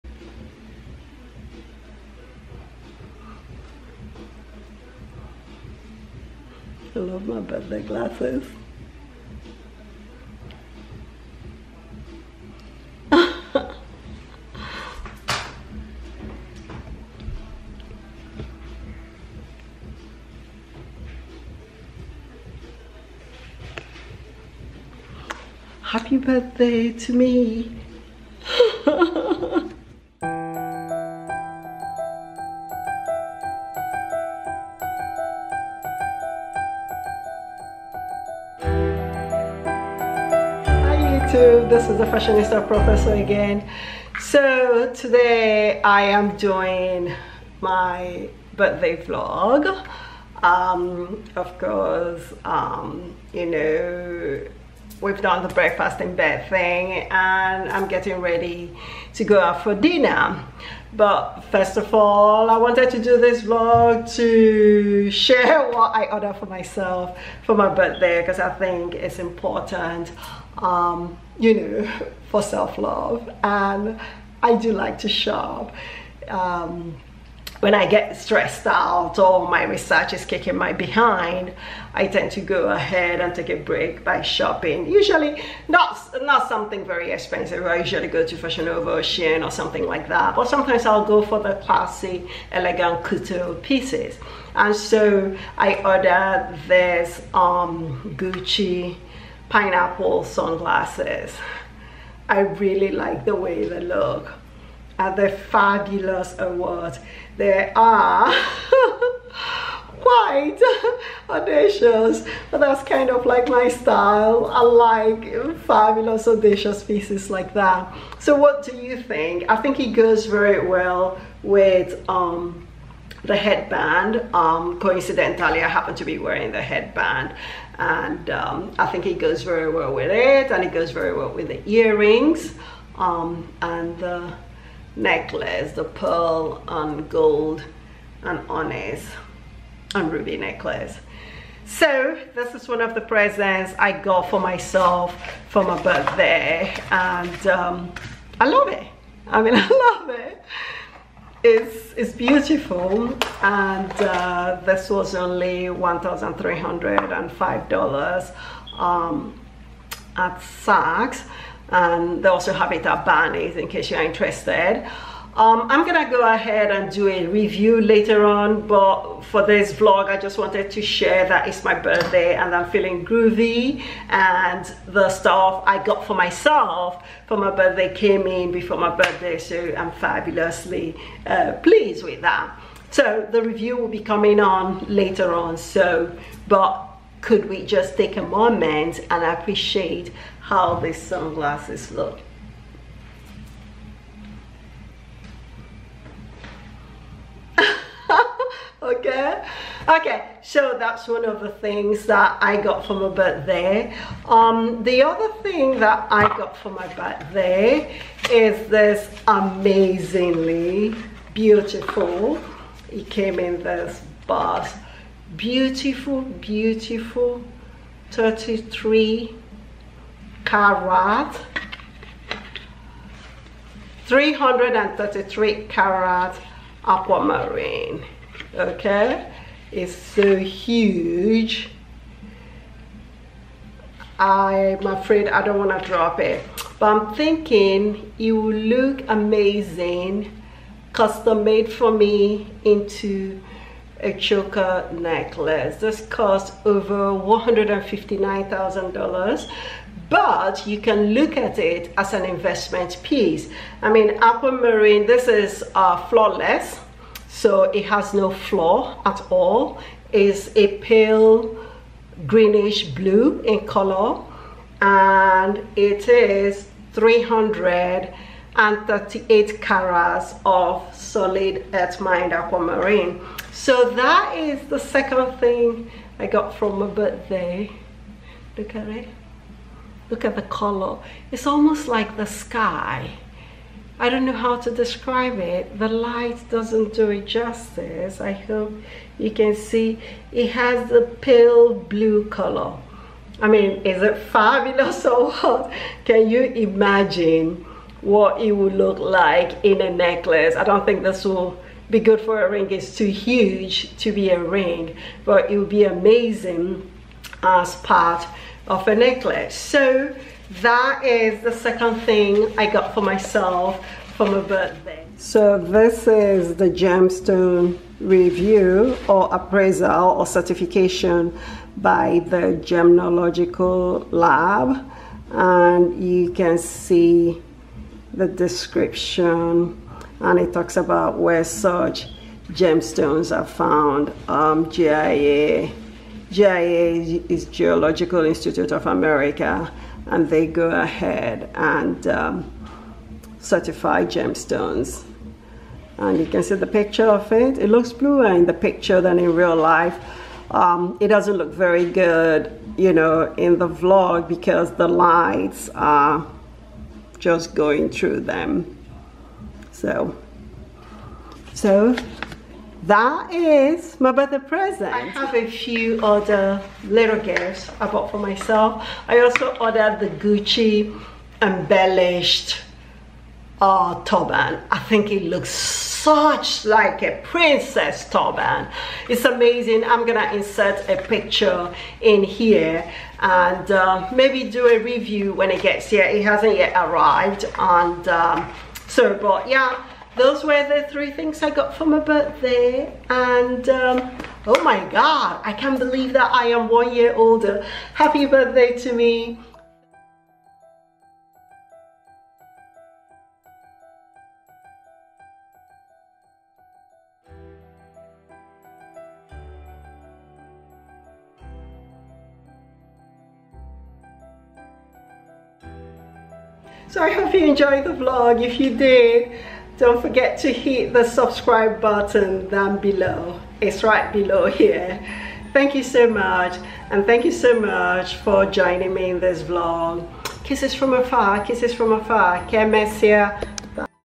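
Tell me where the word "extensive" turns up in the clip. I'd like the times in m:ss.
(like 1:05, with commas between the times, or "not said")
not said.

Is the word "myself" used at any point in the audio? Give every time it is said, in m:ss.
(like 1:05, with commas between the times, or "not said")
1:06, 2:24, 2:56, 5:13, 6:08.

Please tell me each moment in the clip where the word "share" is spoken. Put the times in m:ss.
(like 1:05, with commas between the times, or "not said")
1:05, 2:50.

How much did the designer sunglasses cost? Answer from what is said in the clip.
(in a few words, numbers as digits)
$1,305.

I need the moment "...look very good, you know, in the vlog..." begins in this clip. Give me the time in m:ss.
5:51.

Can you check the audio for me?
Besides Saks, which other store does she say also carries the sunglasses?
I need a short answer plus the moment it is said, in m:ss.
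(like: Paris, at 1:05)
Barney's, at 2:43.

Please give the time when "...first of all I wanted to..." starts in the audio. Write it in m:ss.
1:01.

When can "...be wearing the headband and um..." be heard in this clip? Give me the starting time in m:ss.
2:06.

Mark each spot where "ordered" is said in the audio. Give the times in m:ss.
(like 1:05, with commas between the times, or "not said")
1:06, 1:35, 6:09.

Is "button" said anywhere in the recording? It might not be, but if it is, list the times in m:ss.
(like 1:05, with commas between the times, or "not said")
7:01.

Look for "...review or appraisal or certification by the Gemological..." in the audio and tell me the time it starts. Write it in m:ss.
5:17.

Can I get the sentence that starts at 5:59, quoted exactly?
So, so that is my birthday present.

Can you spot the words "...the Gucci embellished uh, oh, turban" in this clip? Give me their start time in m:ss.
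6:09.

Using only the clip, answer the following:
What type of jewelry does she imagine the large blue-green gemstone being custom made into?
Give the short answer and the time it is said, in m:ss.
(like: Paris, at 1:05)
Choker necklace, at 4:04.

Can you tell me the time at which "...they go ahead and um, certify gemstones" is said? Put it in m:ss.
5:40.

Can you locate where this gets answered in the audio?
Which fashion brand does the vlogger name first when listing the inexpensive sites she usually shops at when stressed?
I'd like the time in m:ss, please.
1:28.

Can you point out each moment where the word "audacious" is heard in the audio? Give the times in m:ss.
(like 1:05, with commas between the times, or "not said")
1:51, 1:56.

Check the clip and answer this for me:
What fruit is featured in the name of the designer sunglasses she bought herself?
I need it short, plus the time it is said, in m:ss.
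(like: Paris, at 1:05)
Pineapple, at 1:39.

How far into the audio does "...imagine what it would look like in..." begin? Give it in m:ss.
4:56.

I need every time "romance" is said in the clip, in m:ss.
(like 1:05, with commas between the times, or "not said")
not said.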